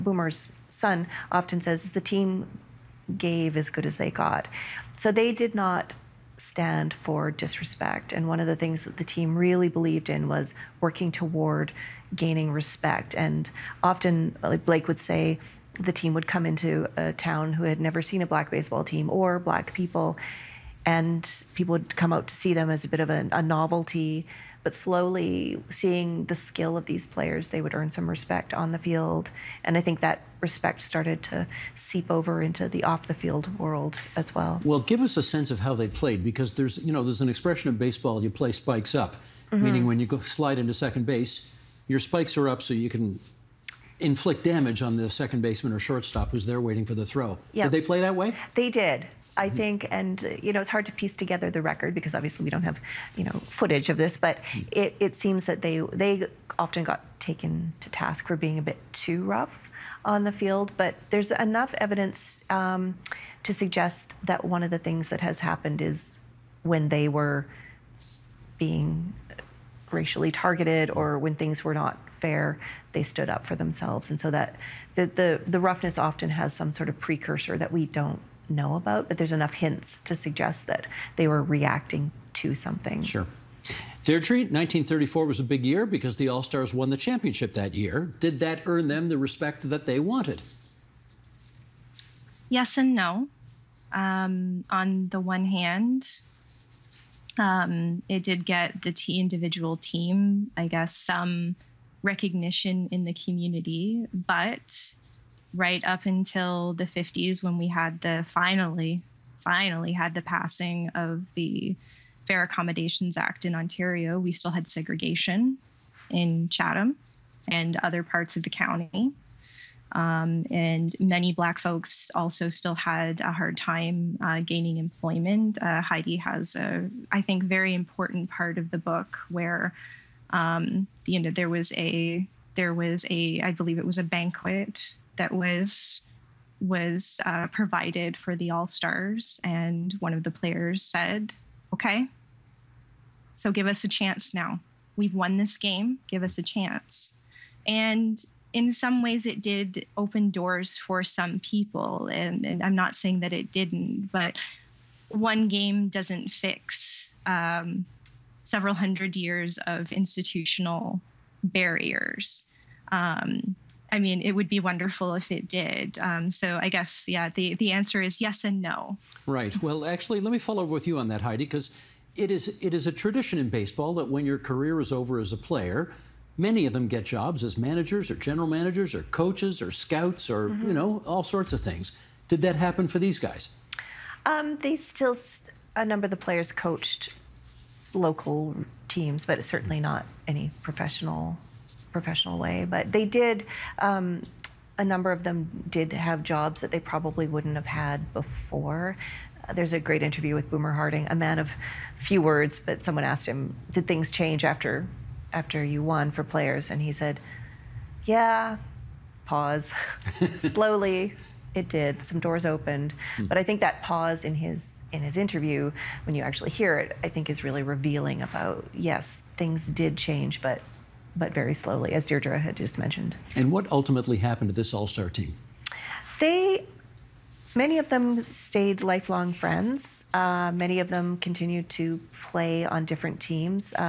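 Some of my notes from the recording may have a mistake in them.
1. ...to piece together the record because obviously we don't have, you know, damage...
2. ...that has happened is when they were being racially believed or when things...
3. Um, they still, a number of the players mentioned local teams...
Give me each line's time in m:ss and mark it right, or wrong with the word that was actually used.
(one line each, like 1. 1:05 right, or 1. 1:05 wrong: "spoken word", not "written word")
1. 0:50 wrong: "footage", not "damage"
2. 1:05 wrong: "targeted", not "believed"
3. 3:04 wrong: "coached", not "mentioned".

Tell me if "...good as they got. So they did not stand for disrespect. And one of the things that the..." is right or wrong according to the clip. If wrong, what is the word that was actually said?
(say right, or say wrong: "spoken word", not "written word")
right.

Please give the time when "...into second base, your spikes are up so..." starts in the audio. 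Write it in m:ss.
0:40.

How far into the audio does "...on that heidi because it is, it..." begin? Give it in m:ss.
2:50.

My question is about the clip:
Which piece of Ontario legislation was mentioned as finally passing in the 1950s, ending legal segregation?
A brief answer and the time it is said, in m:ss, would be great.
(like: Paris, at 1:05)
Fair Accommodations Act, at 1:52.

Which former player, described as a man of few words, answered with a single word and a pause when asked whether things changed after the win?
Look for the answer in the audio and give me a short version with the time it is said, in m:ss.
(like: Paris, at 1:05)
Boomer Harding, at 3:20.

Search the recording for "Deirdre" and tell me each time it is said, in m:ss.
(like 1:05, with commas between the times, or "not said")
1:24, 3:42.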